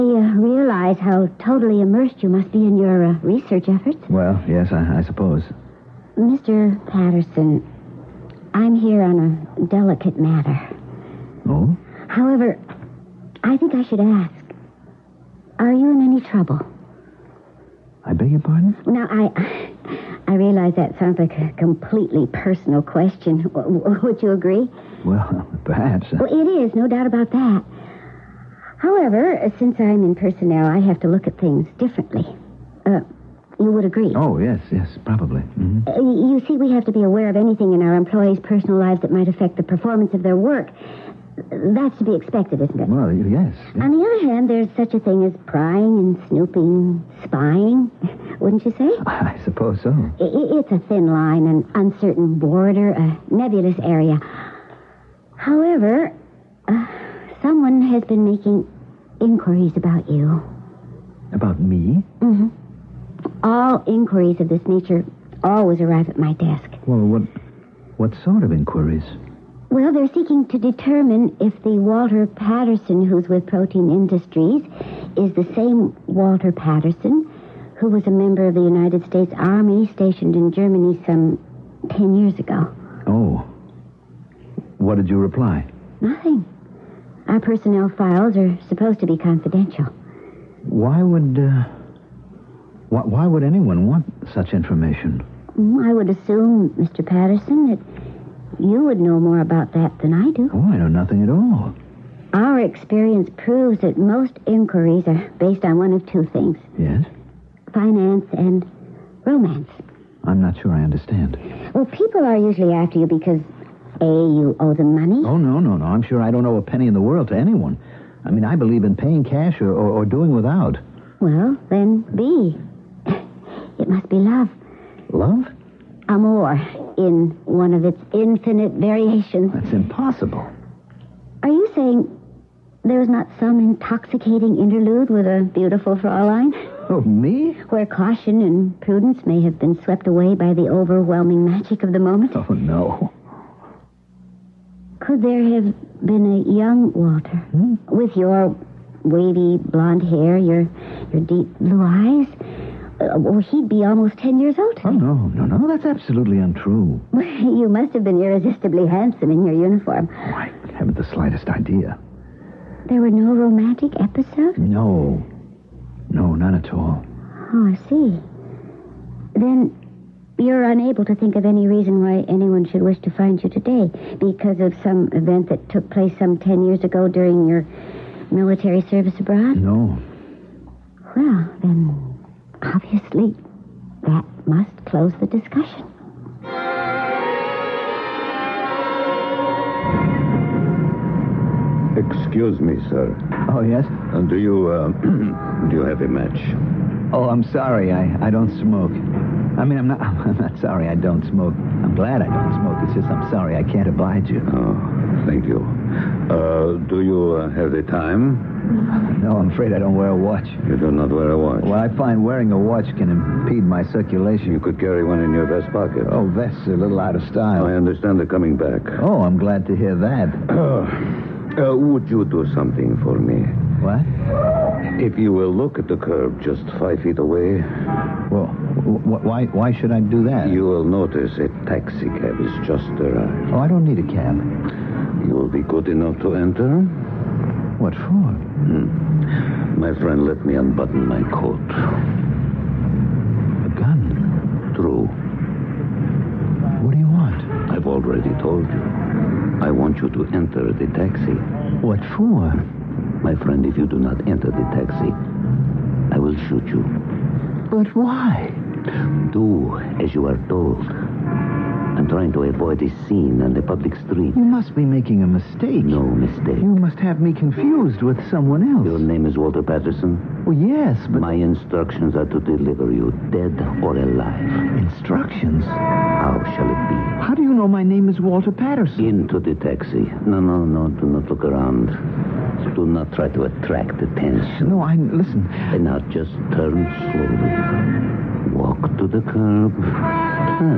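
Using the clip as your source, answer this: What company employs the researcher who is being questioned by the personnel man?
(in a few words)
Protein Industries.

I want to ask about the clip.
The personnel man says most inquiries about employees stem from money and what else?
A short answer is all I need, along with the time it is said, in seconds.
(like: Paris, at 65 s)
Romance, at 109 s.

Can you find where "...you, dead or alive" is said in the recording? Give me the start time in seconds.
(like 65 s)
272 s.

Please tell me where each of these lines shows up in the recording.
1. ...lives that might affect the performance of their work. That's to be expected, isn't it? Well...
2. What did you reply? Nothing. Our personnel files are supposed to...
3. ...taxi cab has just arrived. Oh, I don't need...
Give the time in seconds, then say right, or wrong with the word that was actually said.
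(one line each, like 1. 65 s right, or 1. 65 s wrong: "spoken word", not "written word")
1. 38 s right
2. 84 s right
3. 231 s right.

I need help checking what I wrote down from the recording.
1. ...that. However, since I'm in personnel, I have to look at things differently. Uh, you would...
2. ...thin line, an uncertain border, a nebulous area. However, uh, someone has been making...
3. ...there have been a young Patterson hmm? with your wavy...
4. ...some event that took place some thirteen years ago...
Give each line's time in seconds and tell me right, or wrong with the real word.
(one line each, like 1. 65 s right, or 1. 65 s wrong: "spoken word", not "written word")
1. 27 s right
2. 50 s right
3. 145 s wrong: "Walter", not "Patterson"
4. 174 s wrong: "ten", not "thirteen".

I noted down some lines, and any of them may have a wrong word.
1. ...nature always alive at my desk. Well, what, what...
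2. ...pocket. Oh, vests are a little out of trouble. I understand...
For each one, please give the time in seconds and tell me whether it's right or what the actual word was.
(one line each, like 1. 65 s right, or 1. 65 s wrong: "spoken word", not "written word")
1. 64 s wrong: "arrive", not "alive"
2. 215 s wrong: "style", not "trouble".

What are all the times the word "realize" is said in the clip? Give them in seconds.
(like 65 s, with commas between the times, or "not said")
0 s, 20 s.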